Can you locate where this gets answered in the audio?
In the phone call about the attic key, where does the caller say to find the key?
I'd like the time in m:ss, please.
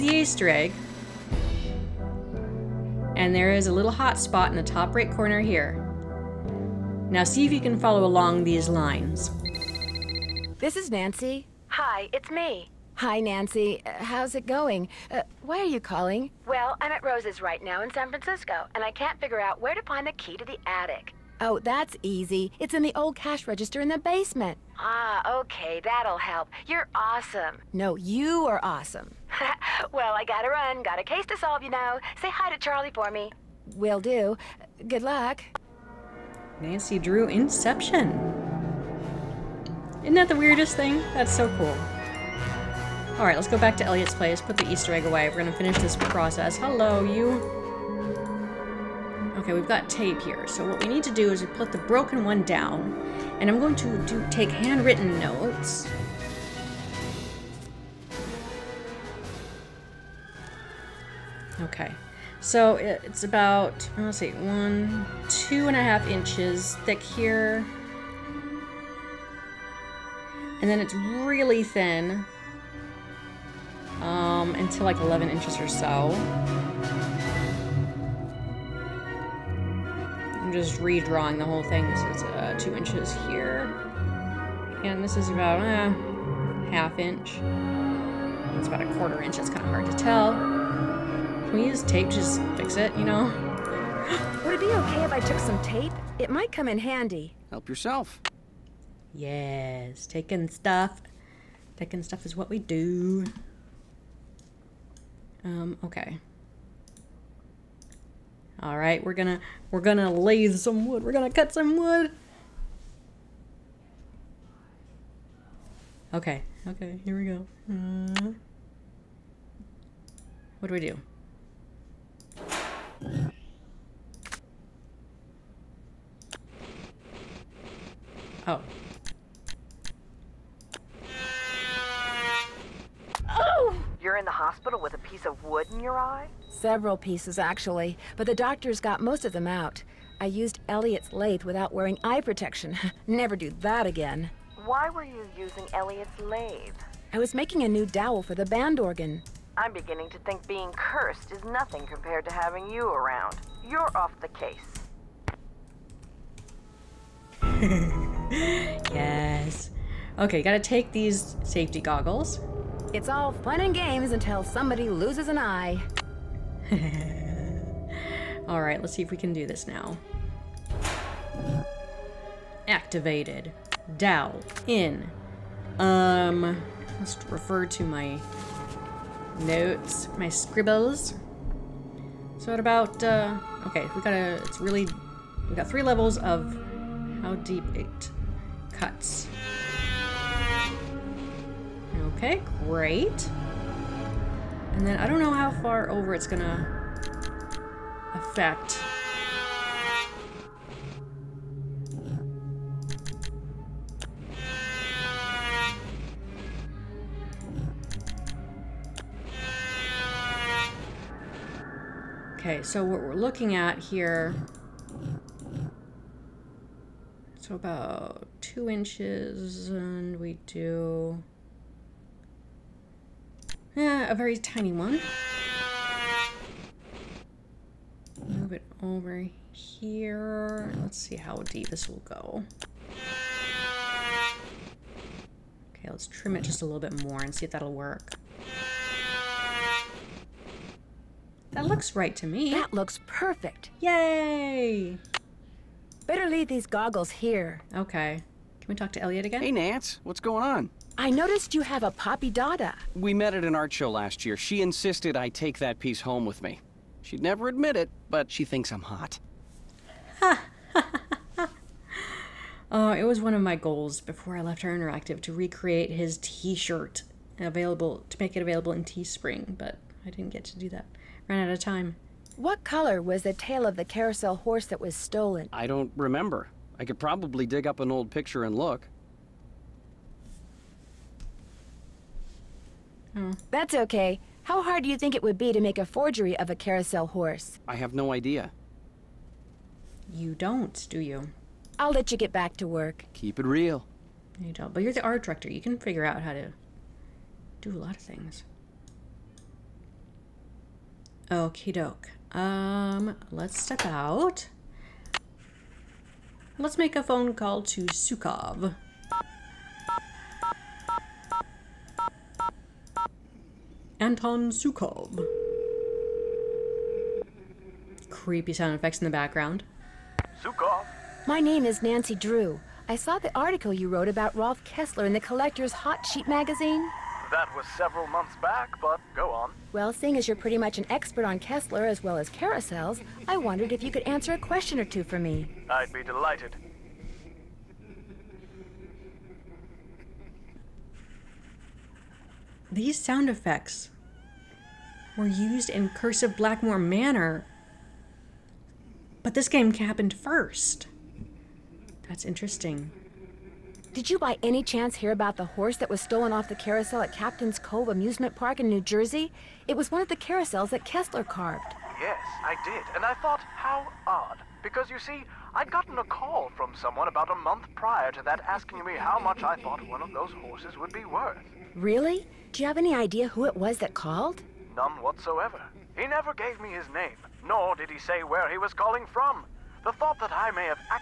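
0:22.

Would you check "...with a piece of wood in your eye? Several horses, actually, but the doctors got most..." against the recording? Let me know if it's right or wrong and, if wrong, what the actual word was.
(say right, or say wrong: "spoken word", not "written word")
wrong: "pieces", not "horses".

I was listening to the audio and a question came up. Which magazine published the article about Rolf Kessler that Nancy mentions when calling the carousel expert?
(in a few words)
Collector's Hot Sheet.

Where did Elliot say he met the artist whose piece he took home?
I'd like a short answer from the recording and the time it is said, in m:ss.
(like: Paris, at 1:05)
An art show, at 4:13.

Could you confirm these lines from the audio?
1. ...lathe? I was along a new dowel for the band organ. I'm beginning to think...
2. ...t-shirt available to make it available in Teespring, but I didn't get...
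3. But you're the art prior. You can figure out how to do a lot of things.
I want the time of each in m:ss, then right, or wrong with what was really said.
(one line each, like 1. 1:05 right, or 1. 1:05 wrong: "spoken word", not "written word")
1. 2:26 wrong: "making", not "along"
2. 4:26 right
3. 4:54 wrong: "director", not "prior".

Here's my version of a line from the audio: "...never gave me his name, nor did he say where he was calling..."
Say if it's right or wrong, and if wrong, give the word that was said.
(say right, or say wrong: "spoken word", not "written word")
right.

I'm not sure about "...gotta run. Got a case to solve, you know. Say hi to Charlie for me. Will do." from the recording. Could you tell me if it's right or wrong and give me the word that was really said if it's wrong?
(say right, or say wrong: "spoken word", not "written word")
right.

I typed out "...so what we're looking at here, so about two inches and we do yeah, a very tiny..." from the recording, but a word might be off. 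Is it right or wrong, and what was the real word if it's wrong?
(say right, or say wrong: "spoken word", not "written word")
right.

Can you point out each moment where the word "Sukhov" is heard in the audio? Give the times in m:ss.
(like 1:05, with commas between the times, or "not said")
5:07, 5:14, 5:20.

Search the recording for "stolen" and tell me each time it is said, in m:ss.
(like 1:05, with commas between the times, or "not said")
4:34, 5:56.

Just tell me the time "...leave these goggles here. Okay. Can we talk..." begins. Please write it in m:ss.
4:06.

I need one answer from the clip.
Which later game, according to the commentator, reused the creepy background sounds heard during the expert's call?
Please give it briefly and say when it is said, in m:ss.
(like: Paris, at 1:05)
Curse of Blackmore Manor, at 5:45.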